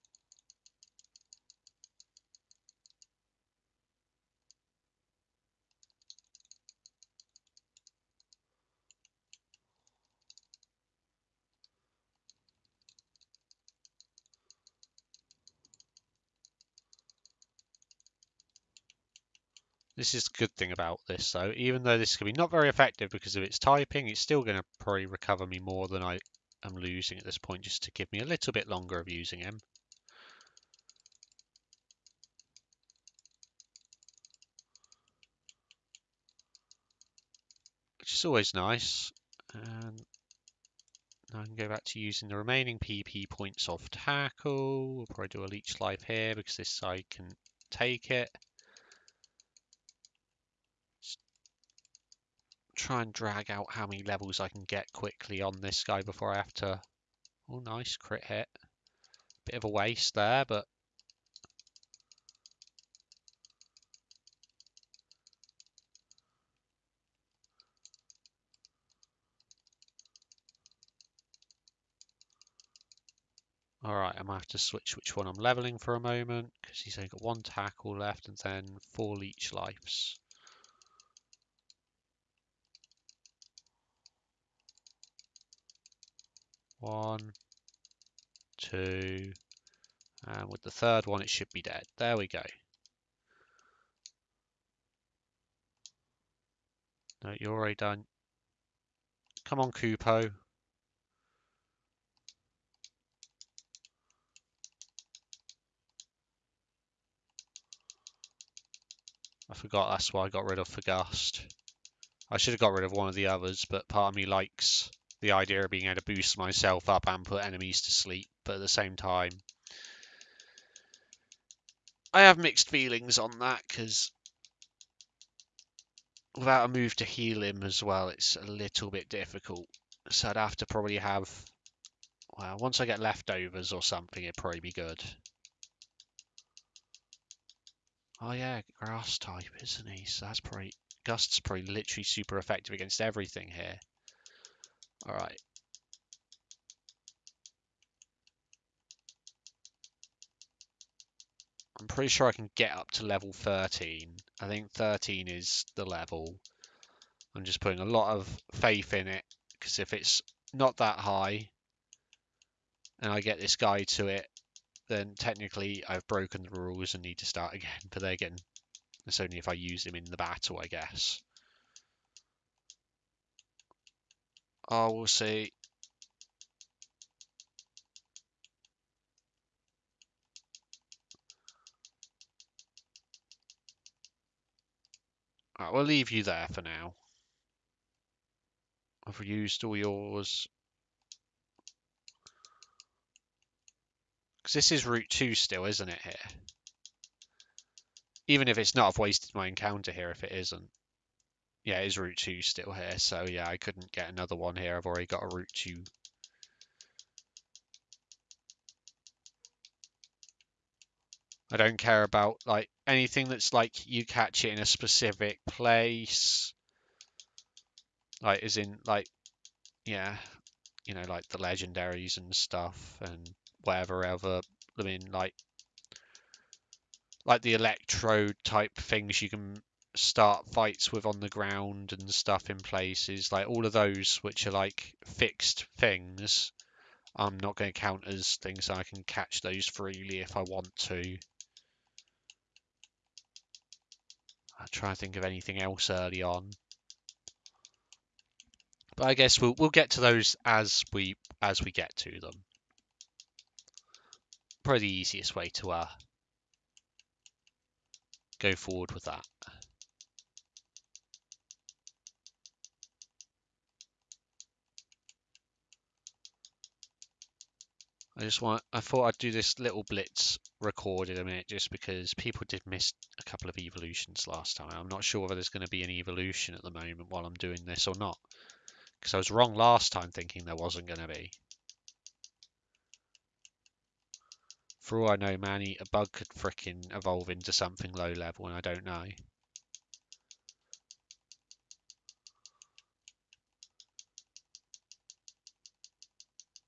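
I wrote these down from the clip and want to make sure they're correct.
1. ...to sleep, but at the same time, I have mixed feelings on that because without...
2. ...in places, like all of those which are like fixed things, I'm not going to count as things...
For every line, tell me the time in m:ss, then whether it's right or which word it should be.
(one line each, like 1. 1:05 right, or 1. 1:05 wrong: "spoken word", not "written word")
1. 1:57 right
2. 3:52 right.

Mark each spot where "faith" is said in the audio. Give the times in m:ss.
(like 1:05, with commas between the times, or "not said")
2:38.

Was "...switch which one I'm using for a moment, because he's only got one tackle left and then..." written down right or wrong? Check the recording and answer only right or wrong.
wrong.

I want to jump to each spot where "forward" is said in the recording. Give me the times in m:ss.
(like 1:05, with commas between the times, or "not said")
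4:18.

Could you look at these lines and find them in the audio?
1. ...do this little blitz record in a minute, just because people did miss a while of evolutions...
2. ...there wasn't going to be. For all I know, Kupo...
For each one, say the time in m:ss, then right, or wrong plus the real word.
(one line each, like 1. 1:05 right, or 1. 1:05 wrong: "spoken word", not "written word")
1. 4:29 wrong: "couple", not "while"
2. 4:40 wrong: "Manny", not "Kupo".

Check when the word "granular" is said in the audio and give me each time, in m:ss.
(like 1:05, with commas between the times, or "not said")
not said.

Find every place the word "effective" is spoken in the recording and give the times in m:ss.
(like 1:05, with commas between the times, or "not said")
0:22, 2:22.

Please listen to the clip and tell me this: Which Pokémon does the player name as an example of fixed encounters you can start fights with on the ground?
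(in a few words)
Electrode.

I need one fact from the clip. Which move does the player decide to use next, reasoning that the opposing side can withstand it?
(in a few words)
Leech Life.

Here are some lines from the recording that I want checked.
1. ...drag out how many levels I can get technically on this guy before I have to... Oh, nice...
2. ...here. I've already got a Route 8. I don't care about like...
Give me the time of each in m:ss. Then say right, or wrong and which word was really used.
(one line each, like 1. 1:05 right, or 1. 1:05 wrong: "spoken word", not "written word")
1. 0:53 wrong: "quickly", not "technically"
2. 3:24 wrong: "2", not "8".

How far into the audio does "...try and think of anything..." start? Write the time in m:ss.
4:04.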